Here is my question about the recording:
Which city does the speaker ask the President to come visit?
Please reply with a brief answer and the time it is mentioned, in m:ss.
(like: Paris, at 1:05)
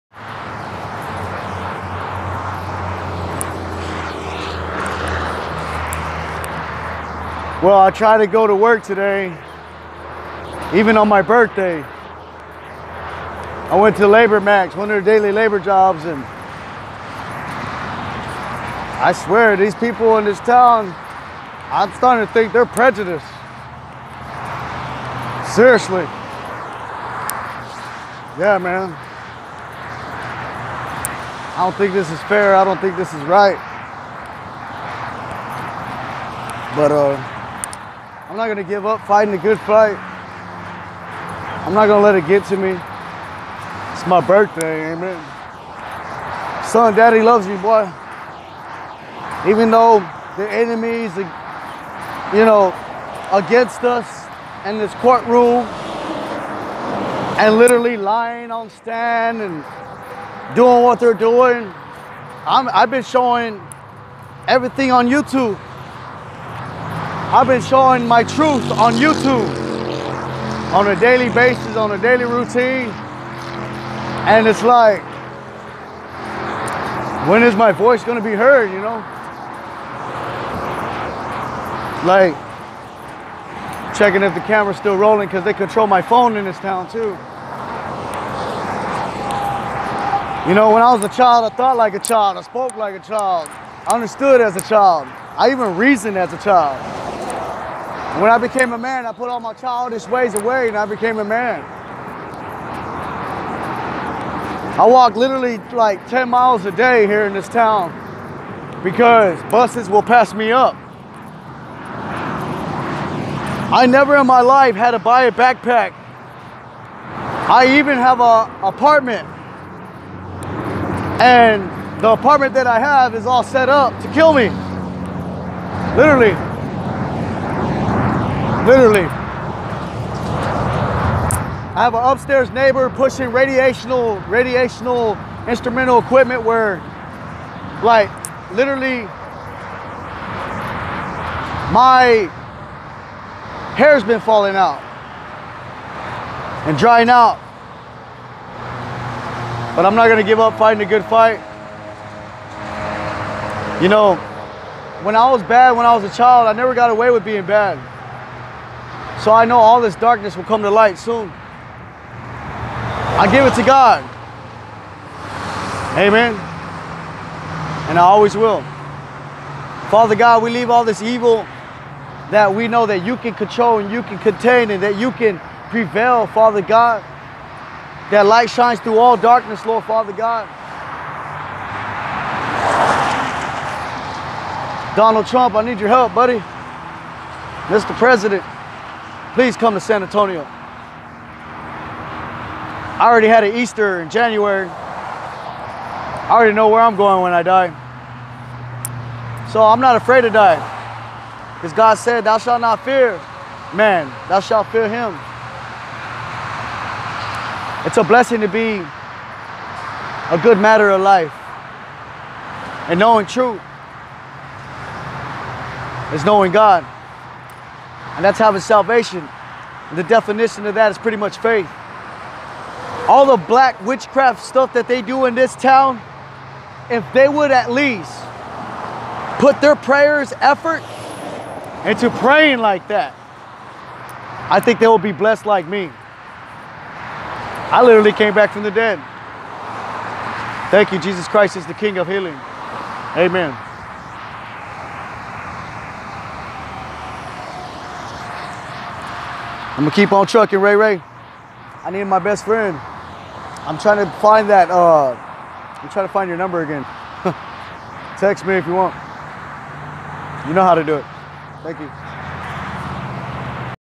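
San Antonio, at 3:09.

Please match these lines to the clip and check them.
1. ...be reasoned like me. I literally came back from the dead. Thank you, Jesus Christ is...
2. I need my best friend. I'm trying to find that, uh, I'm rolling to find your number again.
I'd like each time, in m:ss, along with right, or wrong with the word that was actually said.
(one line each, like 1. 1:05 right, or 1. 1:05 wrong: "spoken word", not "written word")
1. 3:54 wrong: "blessed", not "reasoned"
2. 4:11 wrong: "trying", not "rolling".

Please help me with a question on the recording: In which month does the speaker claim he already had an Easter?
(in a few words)
January.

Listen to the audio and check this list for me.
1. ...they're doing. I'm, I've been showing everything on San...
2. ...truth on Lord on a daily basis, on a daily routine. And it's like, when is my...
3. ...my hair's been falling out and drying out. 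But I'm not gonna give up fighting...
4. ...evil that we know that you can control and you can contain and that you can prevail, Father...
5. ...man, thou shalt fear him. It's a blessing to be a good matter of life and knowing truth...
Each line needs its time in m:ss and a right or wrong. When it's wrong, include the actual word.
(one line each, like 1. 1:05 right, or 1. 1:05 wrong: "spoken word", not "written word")
1. 1:01 wrong: "YouTube", not "San"
2. 1:08 wrong: "YouTube", not "Lord"
3. 2:21 right
4. 2:51 right
5. 3:23 right.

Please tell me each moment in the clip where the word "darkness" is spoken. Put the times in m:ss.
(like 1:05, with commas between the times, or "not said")
2:39, 2:59.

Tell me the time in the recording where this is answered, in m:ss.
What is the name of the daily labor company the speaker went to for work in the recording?
0:14.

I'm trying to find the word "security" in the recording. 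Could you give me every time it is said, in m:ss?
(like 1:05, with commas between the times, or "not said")
not said.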